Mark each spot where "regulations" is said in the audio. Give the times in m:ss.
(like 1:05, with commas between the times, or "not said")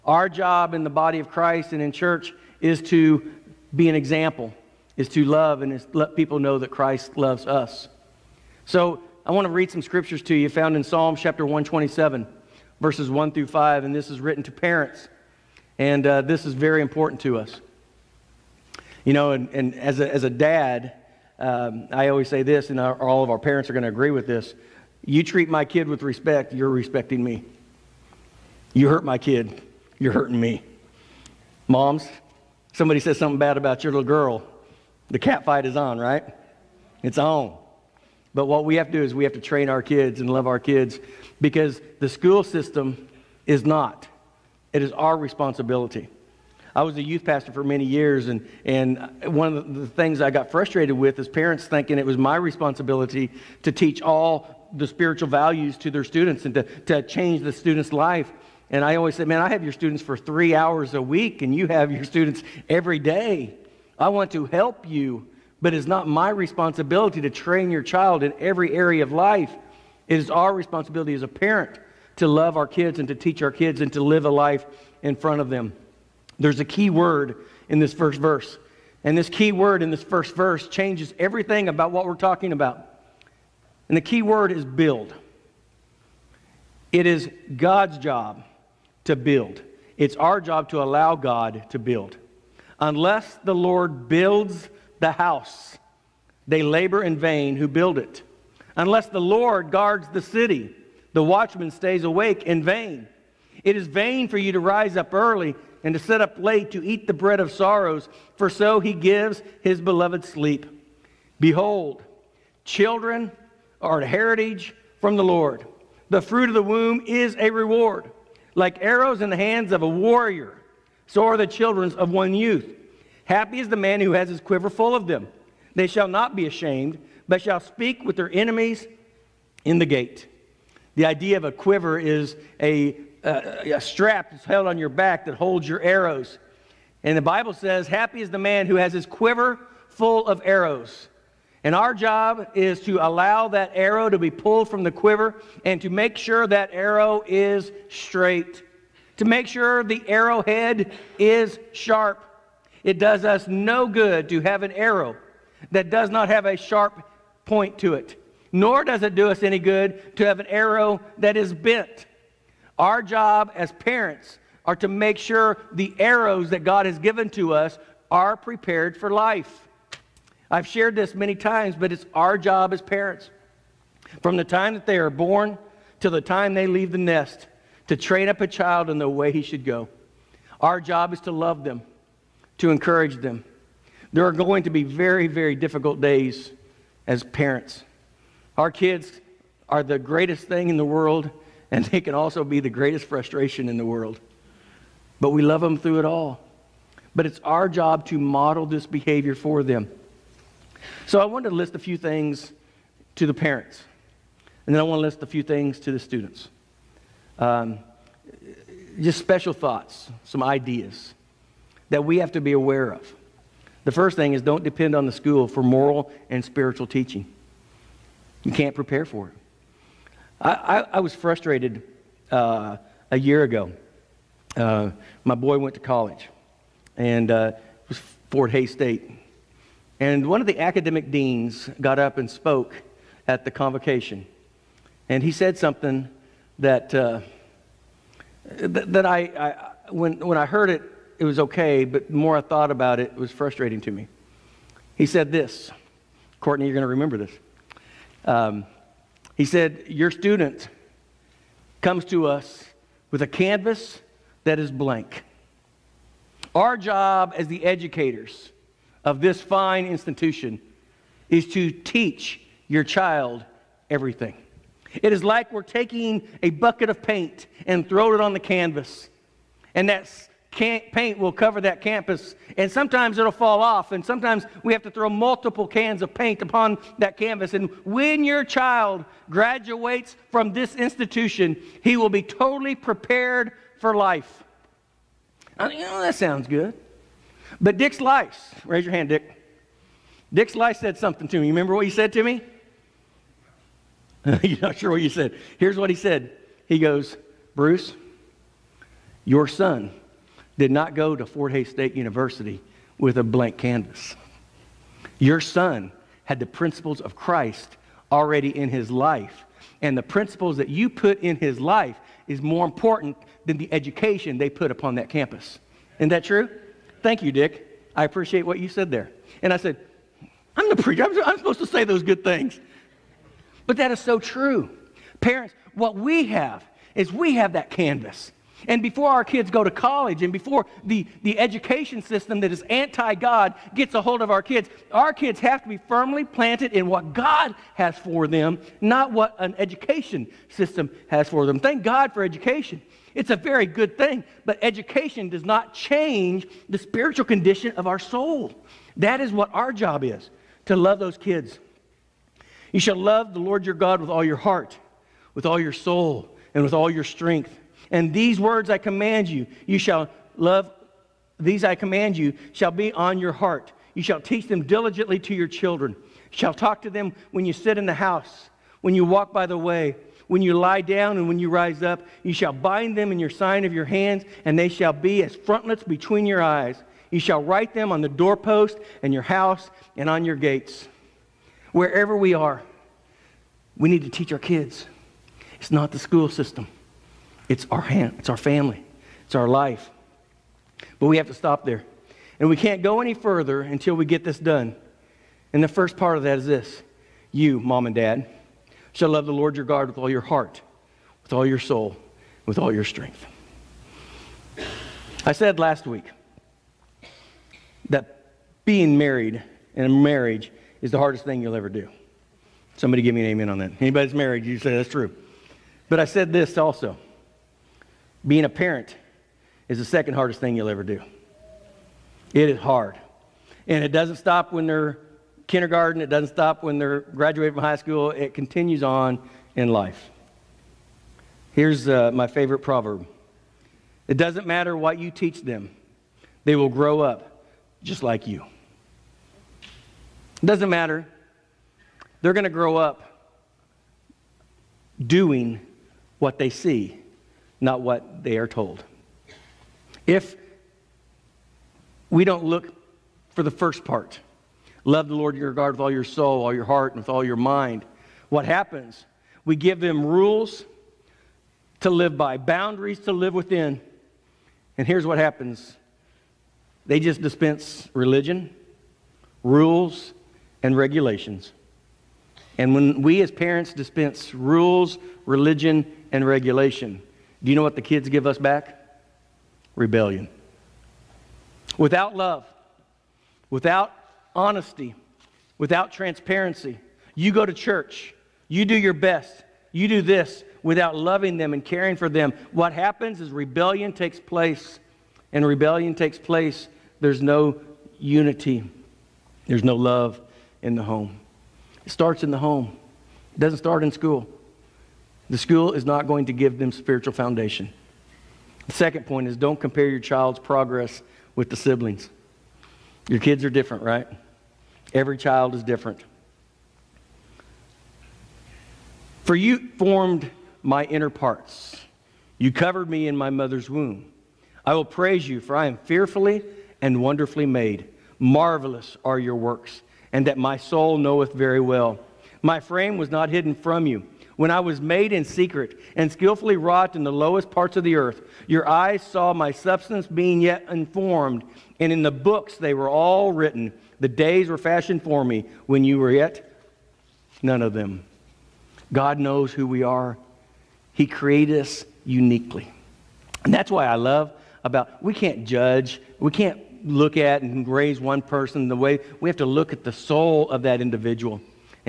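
7:50, 7:56.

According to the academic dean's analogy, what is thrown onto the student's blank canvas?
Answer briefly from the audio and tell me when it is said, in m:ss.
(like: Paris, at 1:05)
A bucket of paint, at 4:26.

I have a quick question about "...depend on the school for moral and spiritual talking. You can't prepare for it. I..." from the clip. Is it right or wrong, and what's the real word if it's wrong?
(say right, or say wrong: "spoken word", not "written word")
wrong: "teaching", not "talking".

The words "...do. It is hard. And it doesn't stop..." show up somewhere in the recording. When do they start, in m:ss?
7:00.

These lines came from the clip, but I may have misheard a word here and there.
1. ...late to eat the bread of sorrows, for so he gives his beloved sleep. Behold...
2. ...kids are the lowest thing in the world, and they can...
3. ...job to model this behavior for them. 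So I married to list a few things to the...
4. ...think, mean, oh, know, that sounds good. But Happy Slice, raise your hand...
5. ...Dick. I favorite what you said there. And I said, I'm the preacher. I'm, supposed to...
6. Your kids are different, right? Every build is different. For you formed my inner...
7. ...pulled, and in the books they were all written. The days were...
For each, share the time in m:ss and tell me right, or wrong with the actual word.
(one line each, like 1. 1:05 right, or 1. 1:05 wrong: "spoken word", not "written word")
1. 1:46 right
2. 3:08 wrong: "greatest", not "lowest"
3. 3:17 wrong: "wanted", not "married"
4. 4:45 wrong: "Dick", not "Happy"
5. 5:17 wrong: "appreciate", not "favorite"
6. 8:33 wrong: "child", not "build"
7. 9:00 wrong: "unformed", not "pulled".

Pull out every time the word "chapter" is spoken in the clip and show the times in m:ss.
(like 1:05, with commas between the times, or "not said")
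0:11.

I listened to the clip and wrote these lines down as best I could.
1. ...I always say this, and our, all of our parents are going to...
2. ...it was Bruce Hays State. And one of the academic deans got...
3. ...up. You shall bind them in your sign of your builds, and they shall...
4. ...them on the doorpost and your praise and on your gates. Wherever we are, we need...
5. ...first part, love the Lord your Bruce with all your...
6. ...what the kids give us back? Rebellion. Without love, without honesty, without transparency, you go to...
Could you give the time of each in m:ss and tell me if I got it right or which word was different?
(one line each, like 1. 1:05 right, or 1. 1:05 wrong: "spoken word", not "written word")
1. 0:21 right
2. 3:47 wrong: "Fort", not "Bruce"
3. 6:11 wrong: "hands", not "builds"
4. 6:17 wrong: "house", not "praise"
5. 7:33 wrong: "God", not "Bruce"
6. 7:57 right.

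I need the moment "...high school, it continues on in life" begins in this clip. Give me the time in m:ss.
7:07.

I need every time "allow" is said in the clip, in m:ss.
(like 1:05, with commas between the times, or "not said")
1:30, 2:23.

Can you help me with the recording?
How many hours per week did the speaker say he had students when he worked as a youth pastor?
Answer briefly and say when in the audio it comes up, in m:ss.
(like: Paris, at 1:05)
3, at 1:00.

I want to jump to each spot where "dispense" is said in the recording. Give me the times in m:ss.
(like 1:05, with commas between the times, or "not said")
7:47, 7:53.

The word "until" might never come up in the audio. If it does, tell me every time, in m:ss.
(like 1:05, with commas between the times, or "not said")
6:33.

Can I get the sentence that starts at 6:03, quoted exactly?
You shall teach them diligently to your children.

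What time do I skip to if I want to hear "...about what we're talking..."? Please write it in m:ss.
1:21.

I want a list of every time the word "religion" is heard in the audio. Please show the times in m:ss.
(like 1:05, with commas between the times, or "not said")
7:47, 7:55.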